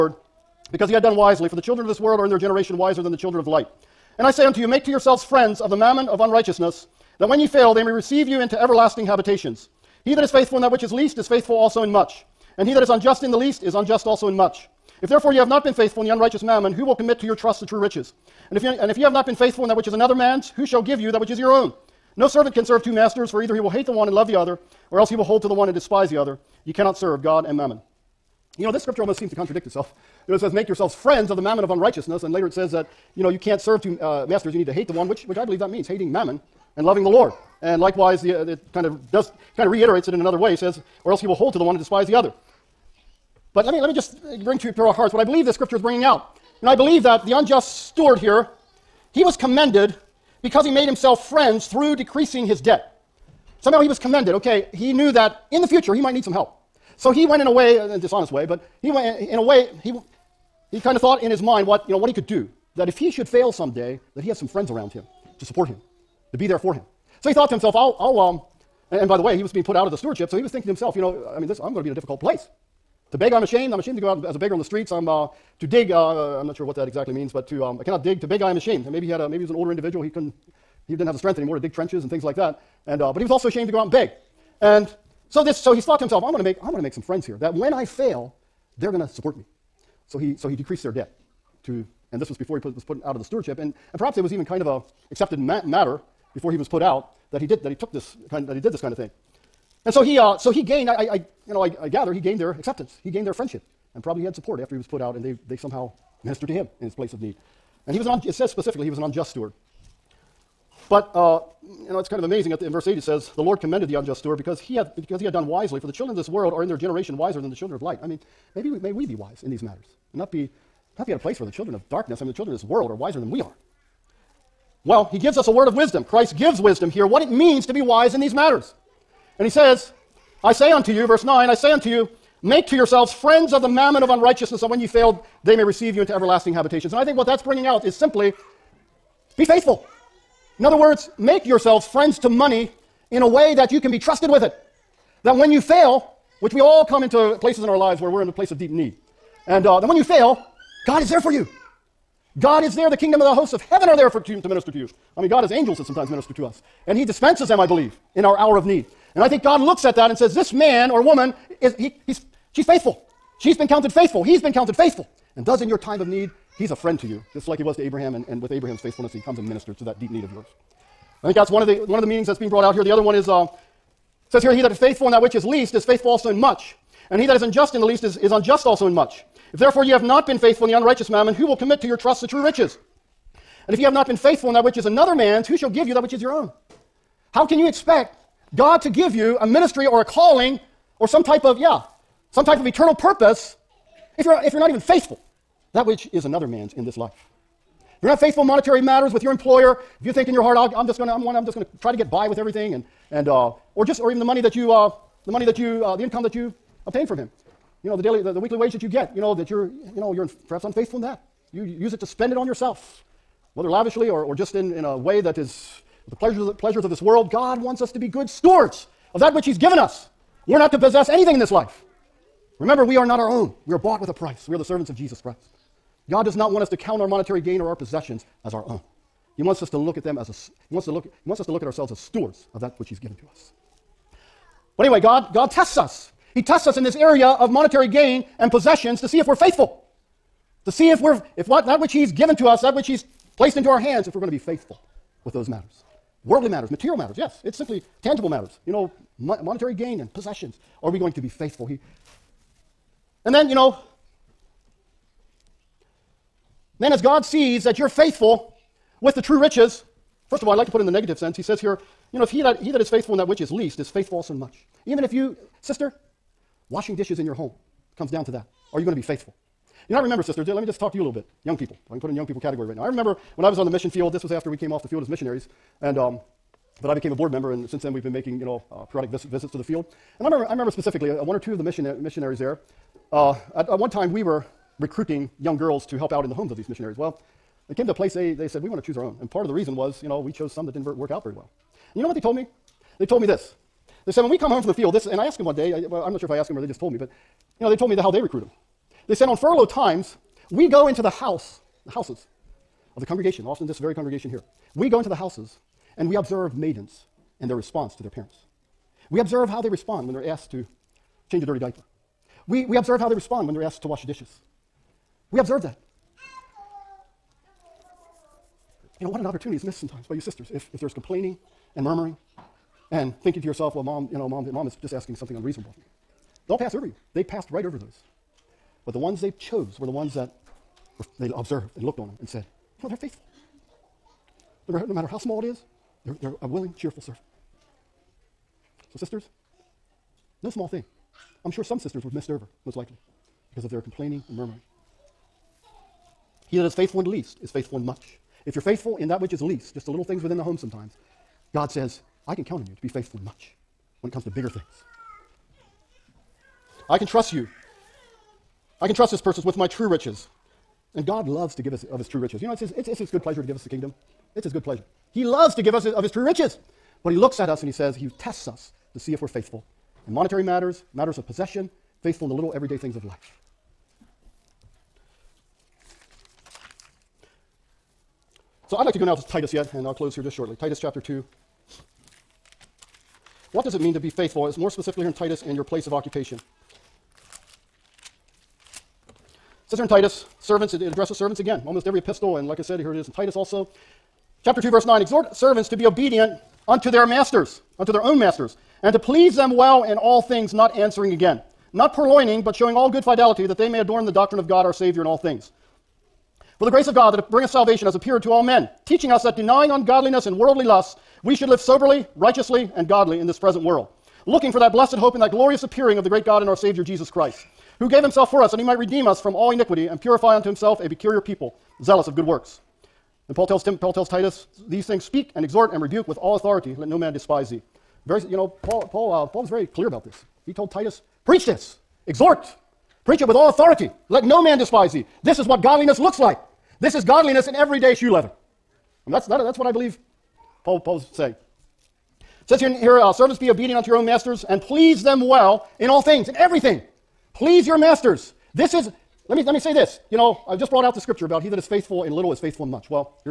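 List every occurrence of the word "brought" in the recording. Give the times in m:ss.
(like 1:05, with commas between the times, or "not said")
2:52, 7:30.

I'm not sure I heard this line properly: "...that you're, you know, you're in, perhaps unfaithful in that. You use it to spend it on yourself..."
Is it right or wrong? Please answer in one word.
right.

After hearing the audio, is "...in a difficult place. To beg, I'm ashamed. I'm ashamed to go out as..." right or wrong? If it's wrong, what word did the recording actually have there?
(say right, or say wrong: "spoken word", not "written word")
right.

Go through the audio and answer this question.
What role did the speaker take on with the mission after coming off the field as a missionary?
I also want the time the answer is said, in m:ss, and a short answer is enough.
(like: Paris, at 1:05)
Board member, at 4:37.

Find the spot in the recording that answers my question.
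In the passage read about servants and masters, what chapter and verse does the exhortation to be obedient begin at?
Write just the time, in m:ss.
6:34.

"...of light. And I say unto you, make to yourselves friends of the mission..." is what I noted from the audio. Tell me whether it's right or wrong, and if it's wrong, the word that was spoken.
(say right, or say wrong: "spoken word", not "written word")
wrong: "mammon", not "mission".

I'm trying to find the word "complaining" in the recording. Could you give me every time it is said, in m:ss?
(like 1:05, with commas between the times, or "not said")
5:20, 5:43.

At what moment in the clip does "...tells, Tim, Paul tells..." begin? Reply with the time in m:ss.
7:03.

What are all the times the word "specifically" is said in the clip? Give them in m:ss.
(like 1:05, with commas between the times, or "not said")
1:48, 4:40, 6:24.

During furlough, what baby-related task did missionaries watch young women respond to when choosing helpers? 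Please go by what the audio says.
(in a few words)
Change a dirty diaper.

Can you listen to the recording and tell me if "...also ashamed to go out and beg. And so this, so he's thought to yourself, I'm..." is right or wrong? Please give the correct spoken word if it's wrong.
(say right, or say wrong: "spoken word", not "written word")
wrong: "himself", not "yourself".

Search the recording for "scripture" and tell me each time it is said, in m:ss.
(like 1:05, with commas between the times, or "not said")
0:28, 0:45, 7:30.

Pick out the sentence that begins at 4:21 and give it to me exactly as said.
He says here, you know, if he that, he that is faithful in that which is least is faithful also in much.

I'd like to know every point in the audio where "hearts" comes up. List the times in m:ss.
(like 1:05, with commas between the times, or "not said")
0:44, 3:20.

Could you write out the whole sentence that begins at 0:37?
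And likewise, the, uh, it kind of does, kind of reiterates it in another way.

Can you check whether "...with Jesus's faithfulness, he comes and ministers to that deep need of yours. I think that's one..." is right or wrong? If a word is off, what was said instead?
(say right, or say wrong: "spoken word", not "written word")
wrong: "Abraham", not "Jesus".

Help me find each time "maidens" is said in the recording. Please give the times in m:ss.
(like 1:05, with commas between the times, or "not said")
5:06.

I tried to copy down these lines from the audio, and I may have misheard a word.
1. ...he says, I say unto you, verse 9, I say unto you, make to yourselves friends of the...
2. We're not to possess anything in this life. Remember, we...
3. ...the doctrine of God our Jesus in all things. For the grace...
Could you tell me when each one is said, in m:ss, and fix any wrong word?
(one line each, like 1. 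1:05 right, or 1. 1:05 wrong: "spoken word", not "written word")
1. 2:09 right
2. 3:40 right
3. 6:44 wrong: "Savior", not "Jesus".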